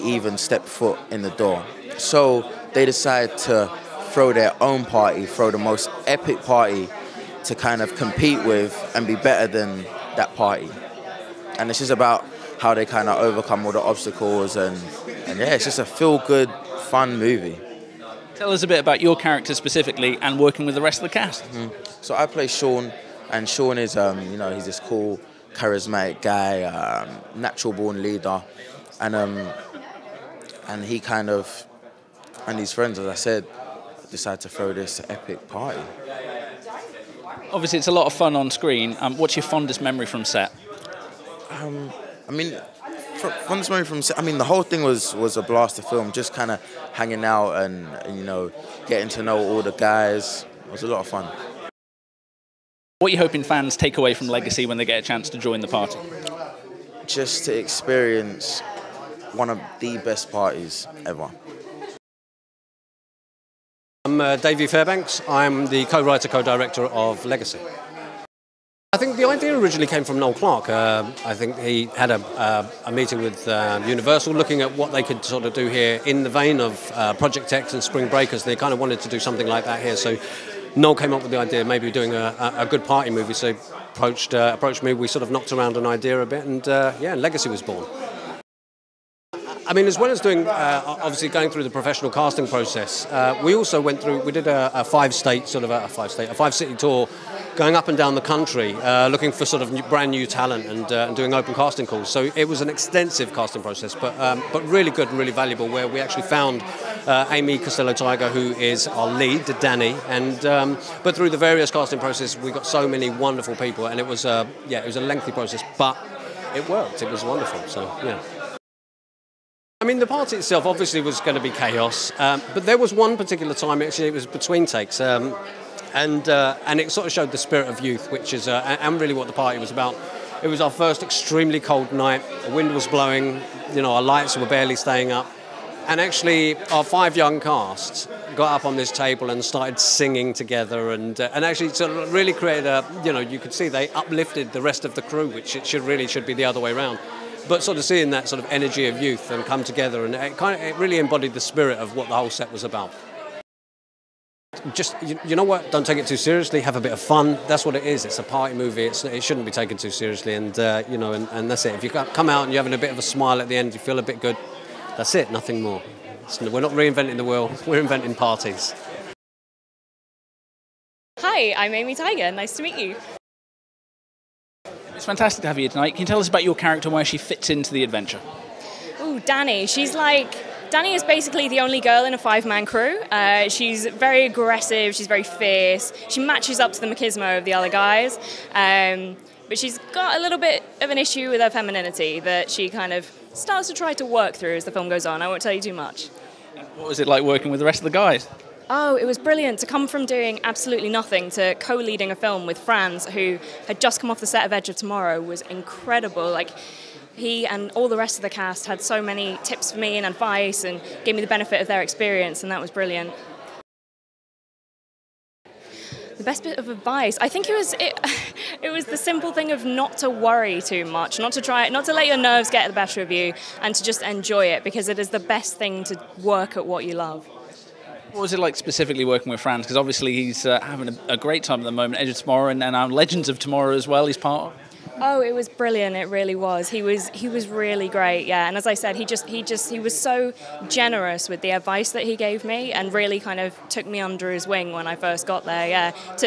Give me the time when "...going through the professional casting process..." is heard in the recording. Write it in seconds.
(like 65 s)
91 s.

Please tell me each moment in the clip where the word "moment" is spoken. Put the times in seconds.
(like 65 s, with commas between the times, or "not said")
43 s, 231 s.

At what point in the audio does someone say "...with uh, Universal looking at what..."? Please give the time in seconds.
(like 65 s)
73 s.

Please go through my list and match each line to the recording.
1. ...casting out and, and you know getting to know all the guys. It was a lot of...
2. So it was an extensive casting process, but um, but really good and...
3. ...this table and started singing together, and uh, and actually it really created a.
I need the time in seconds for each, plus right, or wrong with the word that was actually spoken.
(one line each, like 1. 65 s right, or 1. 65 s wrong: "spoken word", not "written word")
1. 46 s wrong: "hanging", not "casting"
2. 102 s right
3. 138 s right.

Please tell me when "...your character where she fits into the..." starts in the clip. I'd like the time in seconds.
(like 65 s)
176 s.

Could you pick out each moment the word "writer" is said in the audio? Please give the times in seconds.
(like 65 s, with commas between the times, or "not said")
65 s.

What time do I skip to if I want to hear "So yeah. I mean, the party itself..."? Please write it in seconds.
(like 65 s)
117 s.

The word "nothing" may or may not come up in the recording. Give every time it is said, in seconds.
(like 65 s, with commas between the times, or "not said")
165 s, 200 s.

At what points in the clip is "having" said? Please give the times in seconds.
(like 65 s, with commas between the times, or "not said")
162 s, 230 s.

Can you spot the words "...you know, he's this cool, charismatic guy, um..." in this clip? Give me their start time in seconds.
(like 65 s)
24 s.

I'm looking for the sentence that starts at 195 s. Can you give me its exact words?
I won't tell you too much.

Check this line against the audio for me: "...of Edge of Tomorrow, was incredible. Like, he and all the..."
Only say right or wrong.
right.